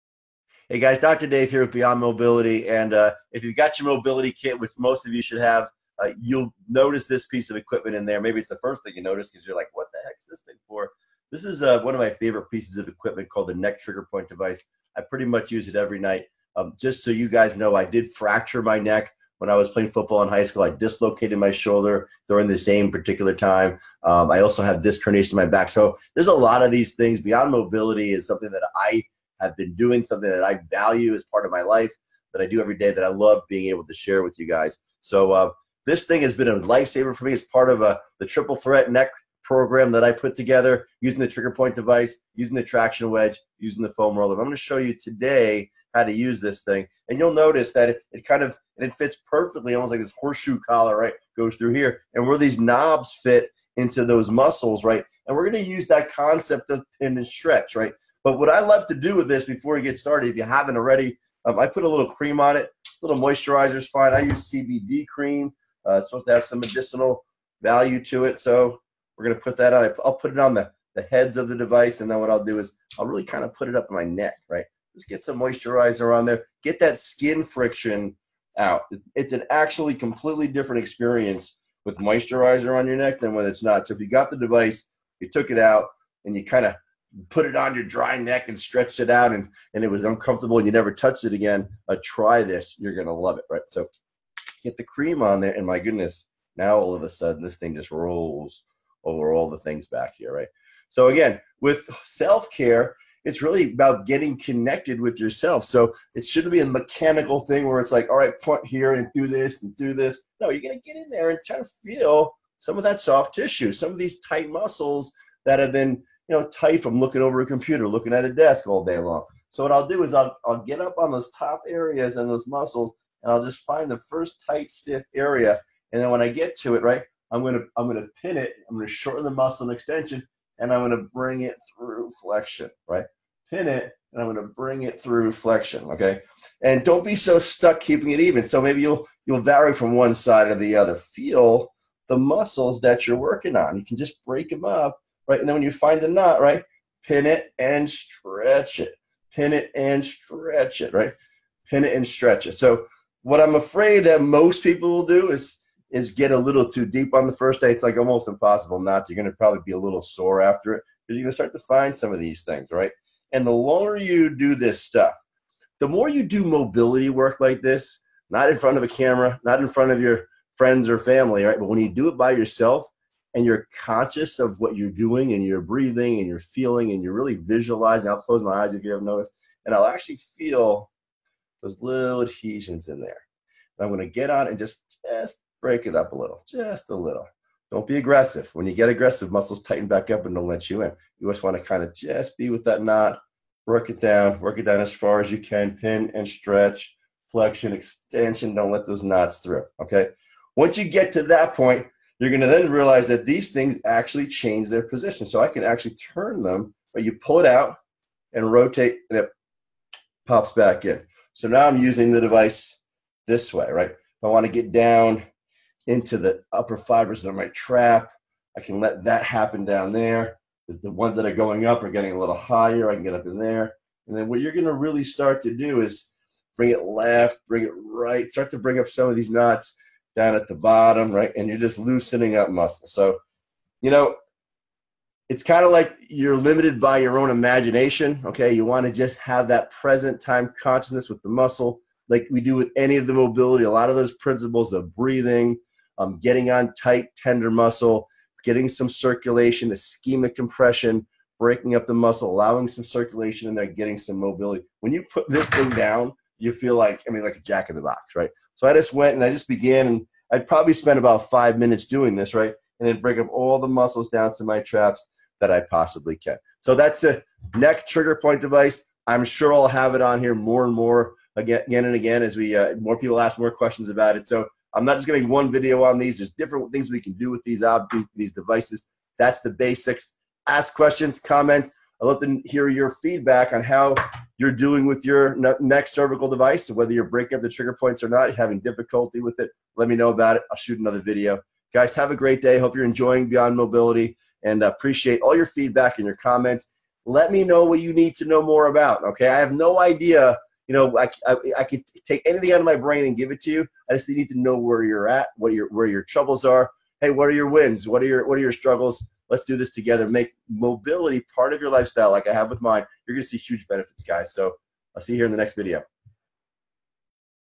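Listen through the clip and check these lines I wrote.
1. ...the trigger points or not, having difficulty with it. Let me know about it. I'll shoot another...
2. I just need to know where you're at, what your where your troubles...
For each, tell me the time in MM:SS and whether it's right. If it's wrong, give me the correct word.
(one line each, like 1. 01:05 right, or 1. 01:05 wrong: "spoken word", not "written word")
1. 04:47 right
2. 05:03 right.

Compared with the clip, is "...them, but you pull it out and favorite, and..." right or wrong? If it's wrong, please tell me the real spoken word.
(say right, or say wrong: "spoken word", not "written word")
wrong: "rotate", not "favorite".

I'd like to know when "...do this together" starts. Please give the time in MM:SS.
05:09.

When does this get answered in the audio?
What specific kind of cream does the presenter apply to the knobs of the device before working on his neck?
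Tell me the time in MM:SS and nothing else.
01:04.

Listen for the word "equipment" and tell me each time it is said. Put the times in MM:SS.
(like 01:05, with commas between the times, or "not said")
00:07, 00:12.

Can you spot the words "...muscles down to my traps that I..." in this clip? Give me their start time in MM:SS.
04:23.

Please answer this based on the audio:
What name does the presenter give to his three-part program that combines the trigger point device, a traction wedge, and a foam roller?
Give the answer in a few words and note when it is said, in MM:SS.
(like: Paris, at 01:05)
triple threat neck program, at 00:38.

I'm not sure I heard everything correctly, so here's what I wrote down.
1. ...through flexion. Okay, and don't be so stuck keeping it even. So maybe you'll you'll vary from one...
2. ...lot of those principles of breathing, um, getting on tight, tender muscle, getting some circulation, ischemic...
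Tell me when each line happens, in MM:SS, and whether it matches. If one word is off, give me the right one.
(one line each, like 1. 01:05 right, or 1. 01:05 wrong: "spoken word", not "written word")
1. 02:15 right
2. 04:03 right.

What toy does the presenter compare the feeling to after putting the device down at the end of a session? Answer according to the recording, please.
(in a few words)
jack in the box.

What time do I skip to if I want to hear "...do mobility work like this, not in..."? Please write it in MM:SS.
02:46.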